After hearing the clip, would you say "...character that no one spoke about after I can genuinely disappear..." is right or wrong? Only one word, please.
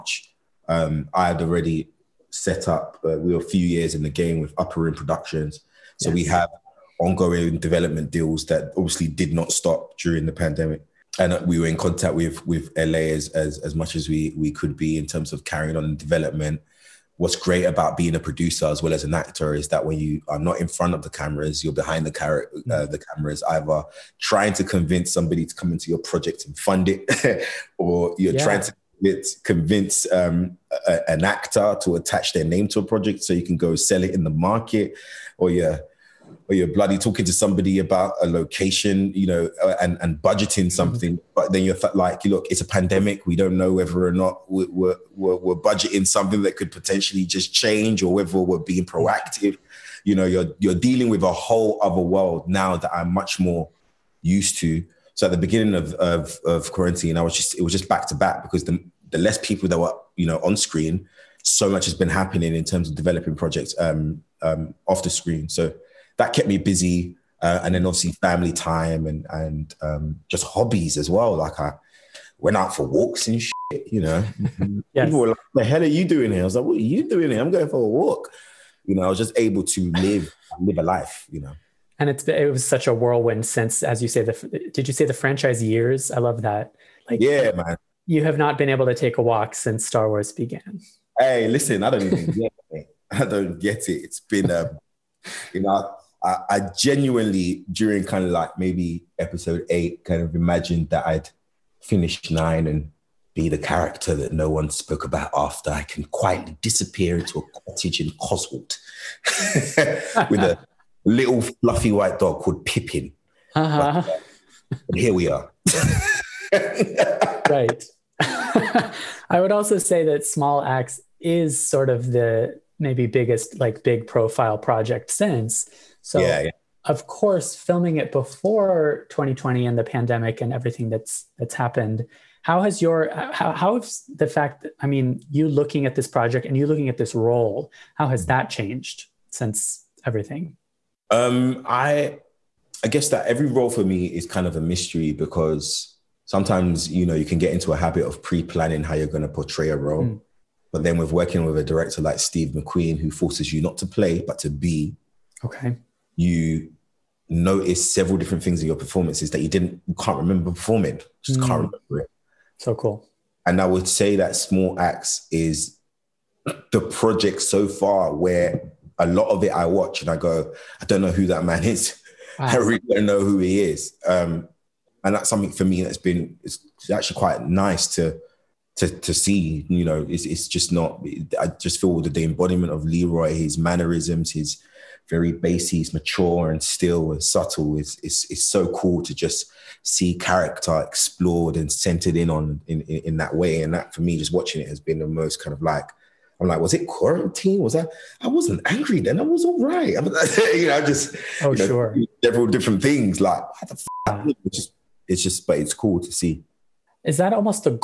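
wrong.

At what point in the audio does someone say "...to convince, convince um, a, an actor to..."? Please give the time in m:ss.
0:28.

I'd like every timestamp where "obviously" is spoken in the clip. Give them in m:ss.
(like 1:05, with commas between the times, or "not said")
0:08, 1:07.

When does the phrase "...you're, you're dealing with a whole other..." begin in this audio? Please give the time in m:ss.
0:50.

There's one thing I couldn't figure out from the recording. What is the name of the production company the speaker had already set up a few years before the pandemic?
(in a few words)
Upperroom Productions.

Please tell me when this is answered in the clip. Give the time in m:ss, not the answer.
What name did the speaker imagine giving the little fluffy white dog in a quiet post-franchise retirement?
1:52.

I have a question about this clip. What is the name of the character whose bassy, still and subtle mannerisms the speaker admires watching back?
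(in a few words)
Leroy.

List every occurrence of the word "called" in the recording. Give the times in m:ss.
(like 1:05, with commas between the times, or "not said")
1:52.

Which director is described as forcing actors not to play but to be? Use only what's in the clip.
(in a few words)
Steve McQueen.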